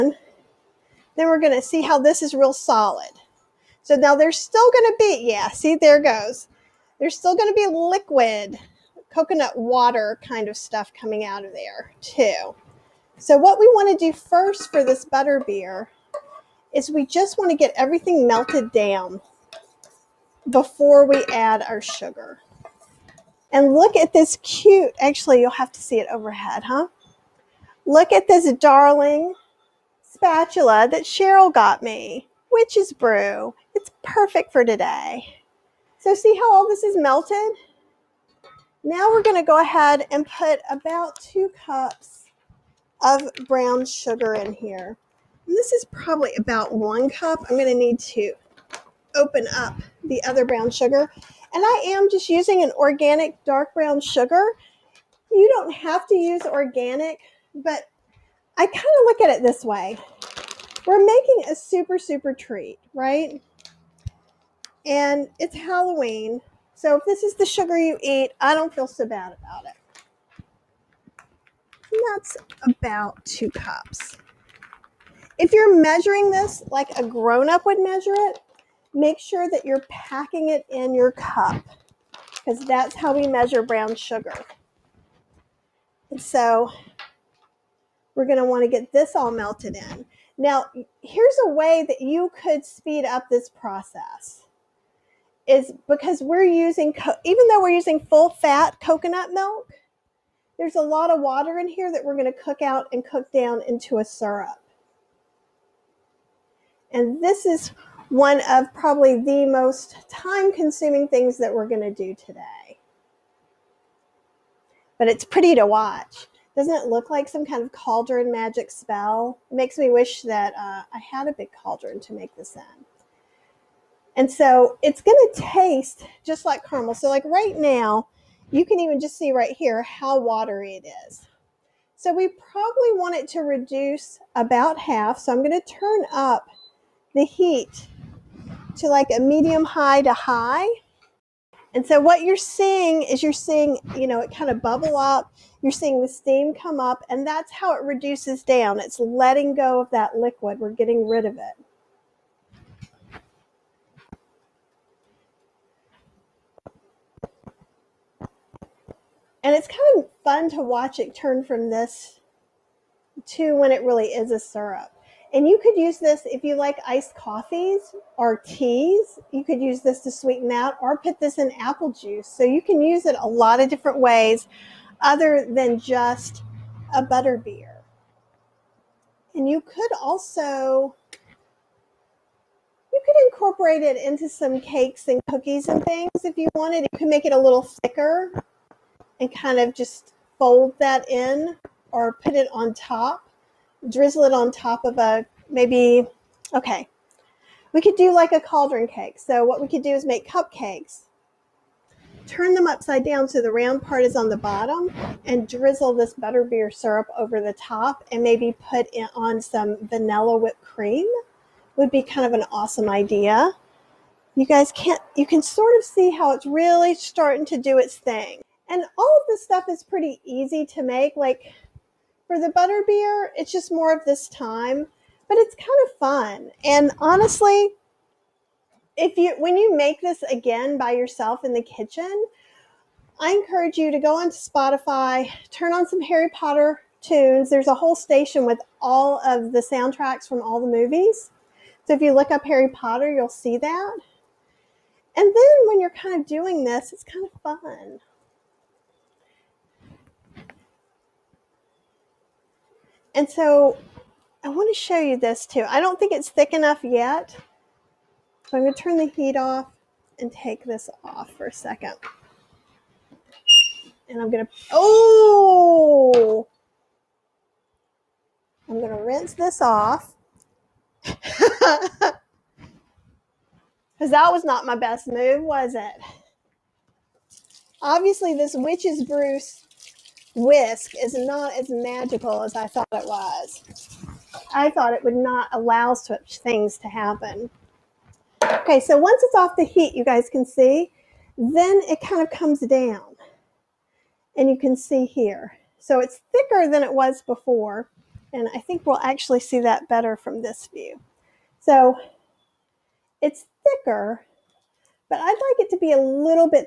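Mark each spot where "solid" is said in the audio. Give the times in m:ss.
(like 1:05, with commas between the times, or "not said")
0:02.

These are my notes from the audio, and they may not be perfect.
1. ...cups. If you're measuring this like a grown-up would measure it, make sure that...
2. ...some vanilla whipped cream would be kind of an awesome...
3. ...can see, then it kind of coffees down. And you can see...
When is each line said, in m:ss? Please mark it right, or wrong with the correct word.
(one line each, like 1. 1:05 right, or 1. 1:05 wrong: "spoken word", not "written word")
1. 1:13 right
2. 3:29 right
3. 4:50 wrong: "comes", not "coffees".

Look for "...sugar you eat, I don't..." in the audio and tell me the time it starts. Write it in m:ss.
1:07.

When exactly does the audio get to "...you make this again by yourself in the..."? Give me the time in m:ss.
3:49.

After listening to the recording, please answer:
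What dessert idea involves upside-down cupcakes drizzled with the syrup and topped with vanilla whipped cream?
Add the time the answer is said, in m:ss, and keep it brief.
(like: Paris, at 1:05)
cauldron cake, at 3:18.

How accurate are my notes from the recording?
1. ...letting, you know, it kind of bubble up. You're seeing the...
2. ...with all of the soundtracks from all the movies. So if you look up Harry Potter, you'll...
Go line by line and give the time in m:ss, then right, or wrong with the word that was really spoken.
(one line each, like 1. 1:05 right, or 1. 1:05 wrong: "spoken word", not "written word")
1. 2:23 wrong: "seeing", not "letting"
2. 3:58 right.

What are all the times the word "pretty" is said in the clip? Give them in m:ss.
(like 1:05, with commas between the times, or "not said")
1:55, 3:39.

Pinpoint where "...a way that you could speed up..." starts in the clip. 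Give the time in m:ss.
1:31.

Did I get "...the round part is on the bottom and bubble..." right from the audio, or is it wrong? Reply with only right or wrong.
wrong.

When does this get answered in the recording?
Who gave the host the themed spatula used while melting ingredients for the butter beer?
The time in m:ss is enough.
0:31.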